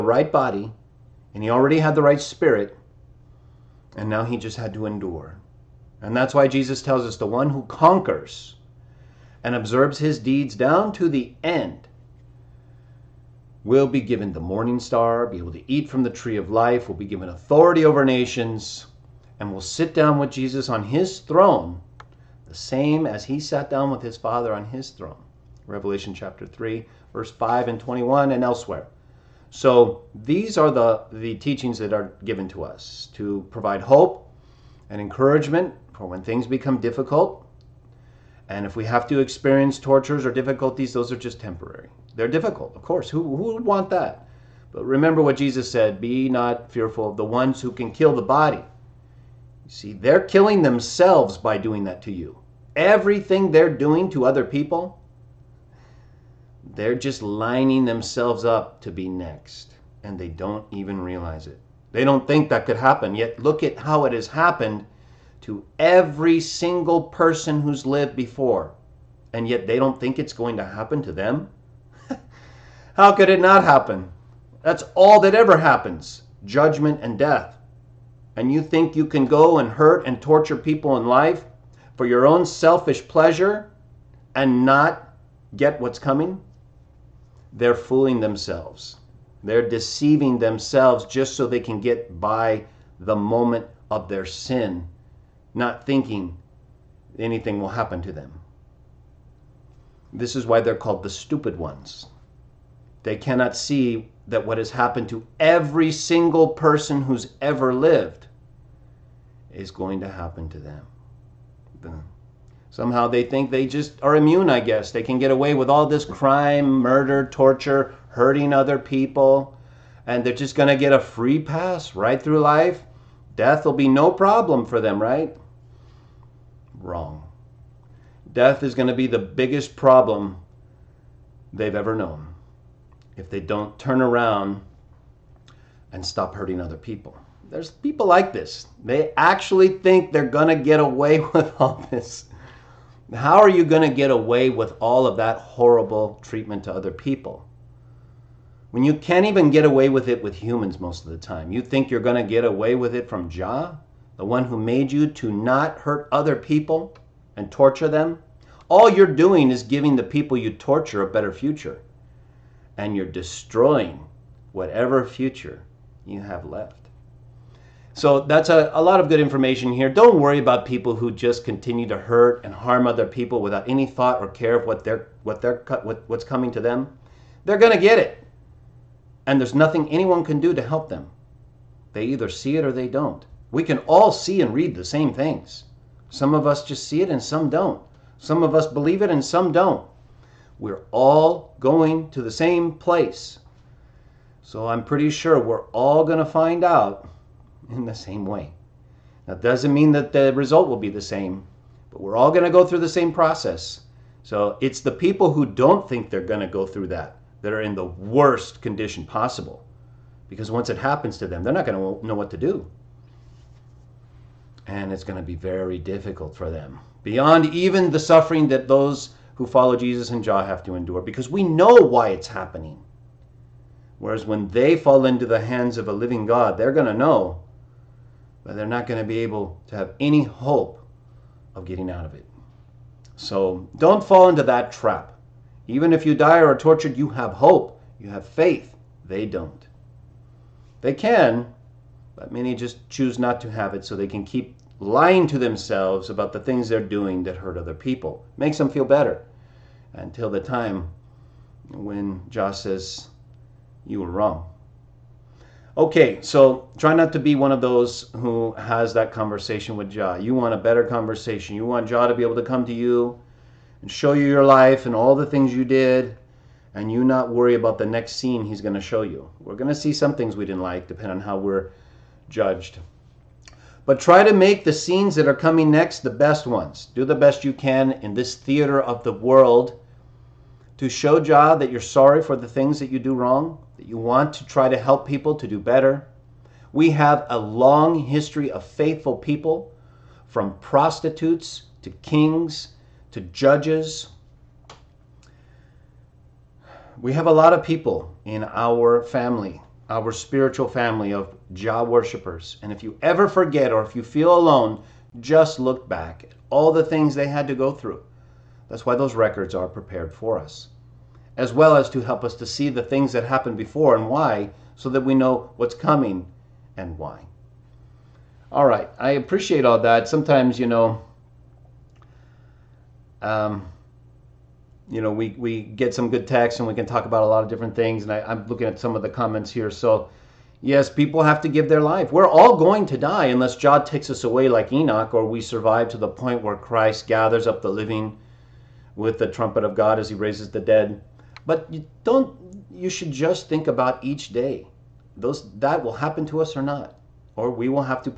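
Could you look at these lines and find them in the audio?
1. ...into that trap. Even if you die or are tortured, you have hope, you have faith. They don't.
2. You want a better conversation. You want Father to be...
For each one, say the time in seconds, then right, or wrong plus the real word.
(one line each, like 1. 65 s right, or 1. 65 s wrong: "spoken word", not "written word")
1. 234 s right
2. 260 s wrong: "Jah", not "Father".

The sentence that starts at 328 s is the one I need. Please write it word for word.
And I, I'm looking at some of the comments here.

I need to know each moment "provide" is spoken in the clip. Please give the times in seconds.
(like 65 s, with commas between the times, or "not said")
33 s.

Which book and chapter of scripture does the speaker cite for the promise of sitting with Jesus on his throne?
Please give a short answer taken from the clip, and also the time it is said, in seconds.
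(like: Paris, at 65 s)
Revelation chapter 3, at 25 s.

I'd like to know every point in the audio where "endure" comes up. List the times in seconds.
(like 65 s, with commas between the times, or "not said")
4 s, 220 s.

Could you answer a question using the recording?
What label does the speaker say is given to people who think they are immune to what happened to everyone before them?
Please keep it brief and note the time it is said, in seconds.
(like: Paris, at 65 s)
the stupid ones, at 101 s.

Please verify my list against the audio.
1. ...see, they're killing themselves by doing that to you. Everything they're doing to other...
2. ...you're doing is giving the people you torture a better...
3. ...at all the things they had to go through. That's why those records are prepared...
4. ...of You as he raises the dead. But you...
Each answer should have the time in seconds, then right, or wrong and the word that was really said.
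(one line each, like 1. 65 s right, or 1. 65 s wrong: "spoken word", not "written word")
1. 49 s right
2. 158 s right
3. 306 s right
4. 339 s wrong: "God", not "You".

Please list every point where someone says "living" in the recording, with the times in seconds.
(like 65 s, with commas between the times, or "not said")
225 s, 337 s.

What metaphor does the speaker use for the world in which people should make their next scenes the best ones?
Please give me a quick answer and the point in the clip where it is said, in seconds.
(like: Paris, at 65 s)
theater, at 278 s.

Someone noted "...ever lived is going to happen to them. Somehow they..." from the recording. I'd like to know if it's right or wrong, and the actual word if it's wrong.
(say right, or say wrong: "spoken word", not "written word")
right.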